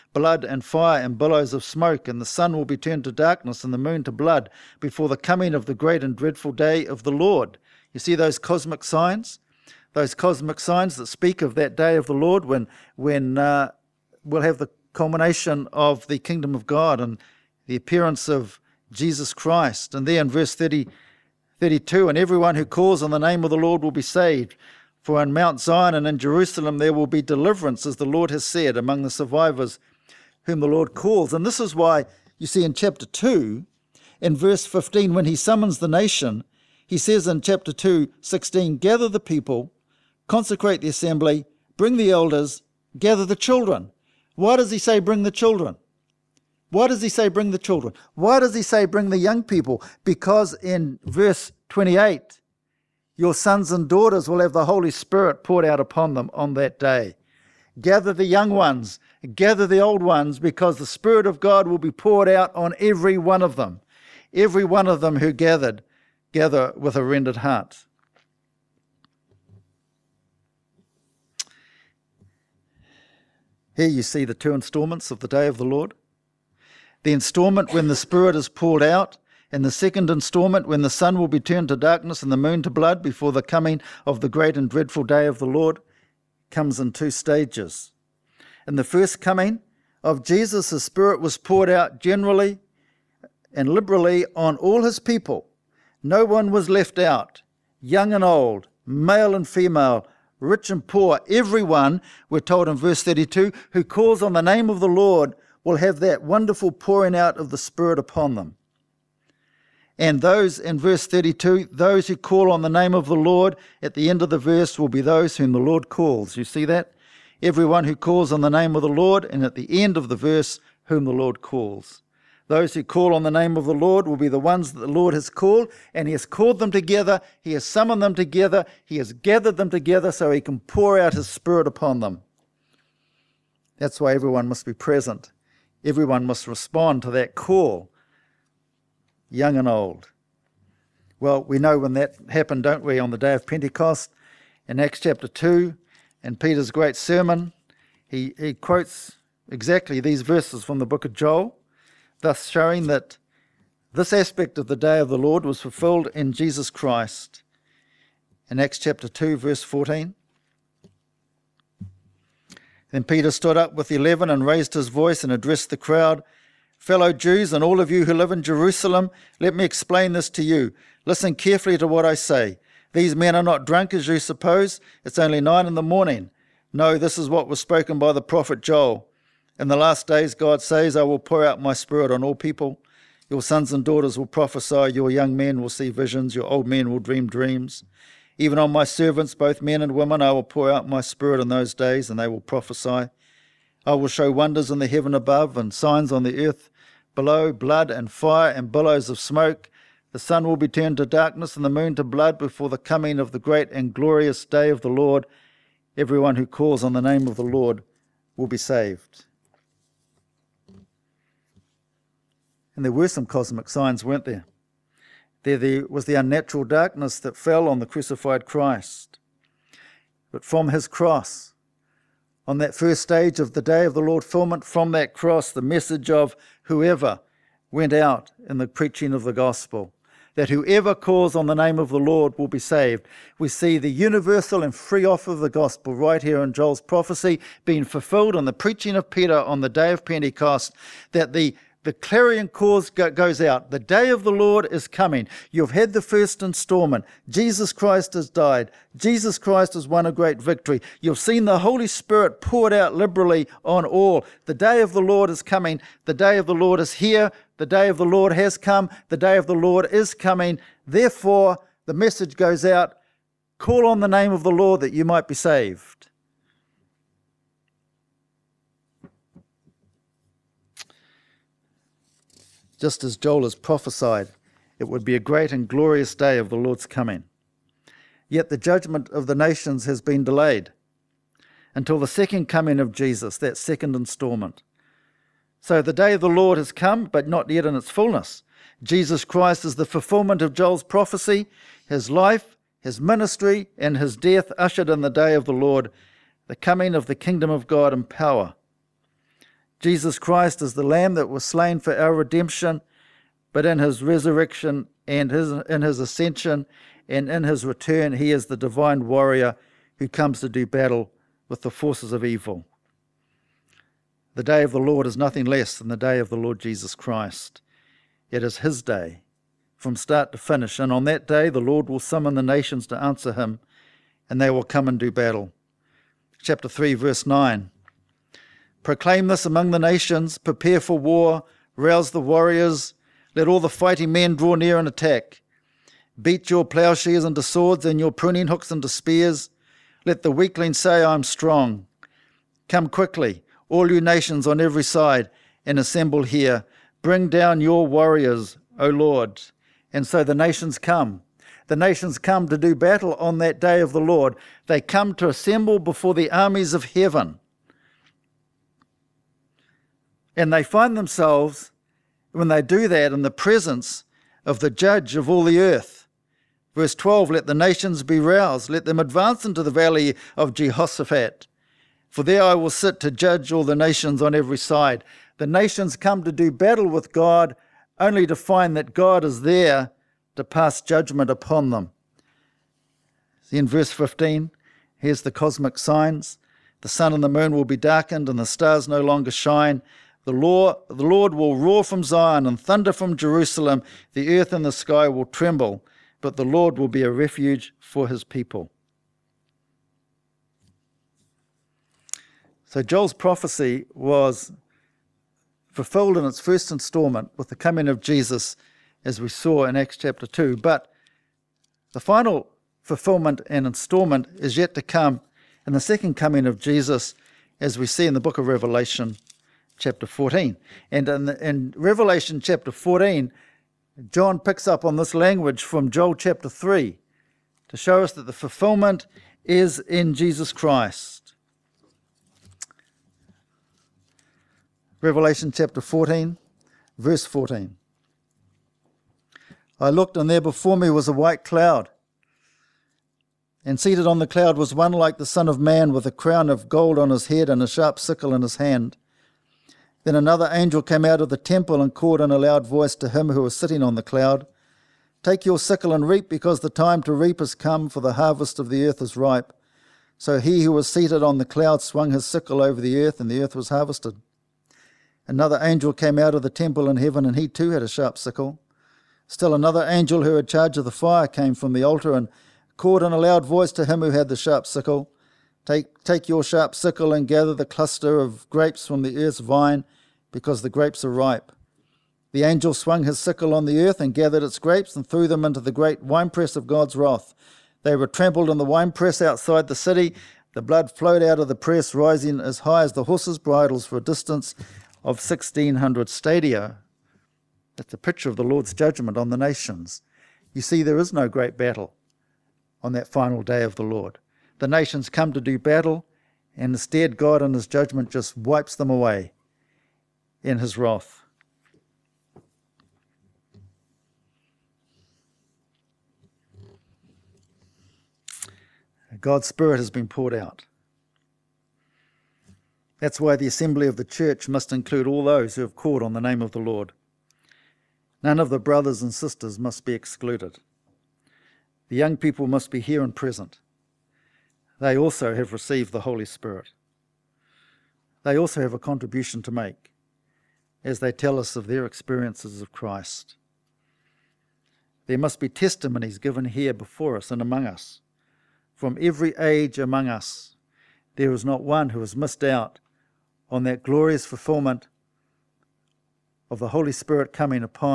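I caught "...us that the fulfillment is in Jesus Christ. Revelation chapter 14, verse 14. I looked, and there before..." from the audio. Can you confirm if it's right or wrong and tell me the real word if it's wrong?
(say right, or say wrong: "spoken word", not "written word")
right.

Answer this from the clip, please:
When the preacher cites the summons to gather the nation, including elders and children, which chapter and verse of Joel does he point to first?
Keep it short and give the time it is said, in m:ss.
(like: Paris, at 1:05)
Chapter 2, verse 15, at 0:32.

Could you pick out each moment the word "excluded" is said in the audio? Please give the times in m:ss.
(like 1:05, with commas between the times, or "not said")
8:49.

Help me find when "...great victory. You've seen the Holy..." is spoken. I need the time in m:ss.
4:10.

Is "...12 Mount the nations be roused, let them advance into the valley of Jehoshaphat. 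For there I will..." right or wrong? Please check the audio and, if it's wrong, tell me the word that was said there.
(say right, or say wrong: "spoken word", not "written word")
wrong: "Let", not "Mount".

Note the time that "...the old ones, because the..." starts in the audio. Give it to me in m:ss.
0:59.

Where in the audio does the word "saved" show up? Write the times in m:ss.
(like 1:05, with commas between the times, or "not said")
0:24, 3:28, 3:52, 4:25.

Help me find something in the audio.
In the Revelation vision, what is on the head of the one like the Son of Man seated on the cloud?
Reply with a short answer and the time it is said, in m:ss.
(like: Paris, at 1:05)
A crown of gold, at 7:26.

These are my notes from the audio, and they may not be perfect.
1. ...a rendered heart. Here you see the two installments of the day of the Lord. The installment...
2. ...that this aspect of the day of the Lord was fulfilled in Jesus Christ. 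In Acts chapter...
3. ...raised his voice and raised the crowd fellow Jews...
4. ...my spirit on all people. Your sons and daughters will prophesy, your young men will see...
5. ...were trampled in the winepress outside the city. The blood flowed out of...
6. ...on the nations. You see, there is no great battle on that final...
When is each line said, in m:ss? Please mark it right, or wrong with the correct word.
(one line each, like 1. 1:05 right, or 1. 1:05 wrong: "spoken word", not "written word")
1. 1:06 right
2. 2:32 right
3. 2:44 wrong: "addressed", not "raised"
4. 3:01 right
5. 8:07 right
6. 8:19 right.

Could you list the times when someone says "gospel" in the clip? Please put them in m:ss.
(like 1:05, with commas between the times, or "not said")
3:49, 3:55.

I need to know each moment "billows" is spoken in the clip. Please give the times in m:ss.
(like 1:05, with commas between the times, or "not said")
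0:01, 3:18.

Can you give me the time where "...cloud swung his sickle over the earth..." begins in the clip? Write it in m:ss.
7:41.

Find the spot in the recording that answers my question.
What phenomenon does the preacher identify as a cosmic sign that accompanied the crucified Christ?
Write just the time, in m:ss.
3:36.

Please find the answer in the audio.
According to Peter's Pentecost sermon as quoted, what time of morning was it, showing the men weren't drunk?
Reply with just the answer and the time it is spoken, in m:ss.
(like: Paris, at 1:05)
9 in the morning, at 2:55.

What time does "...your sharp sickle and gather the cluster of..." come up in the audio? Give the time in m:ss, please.
7:56.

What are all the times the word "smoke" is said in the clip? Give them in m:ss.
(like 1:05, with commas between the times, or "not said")
0:01, 3:19.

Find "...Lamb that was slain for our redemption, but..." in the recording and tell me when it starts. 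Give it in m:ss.
5:00.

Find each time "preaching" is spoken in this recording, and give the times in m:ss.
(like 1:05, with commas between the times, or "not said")
3:48, 3:58.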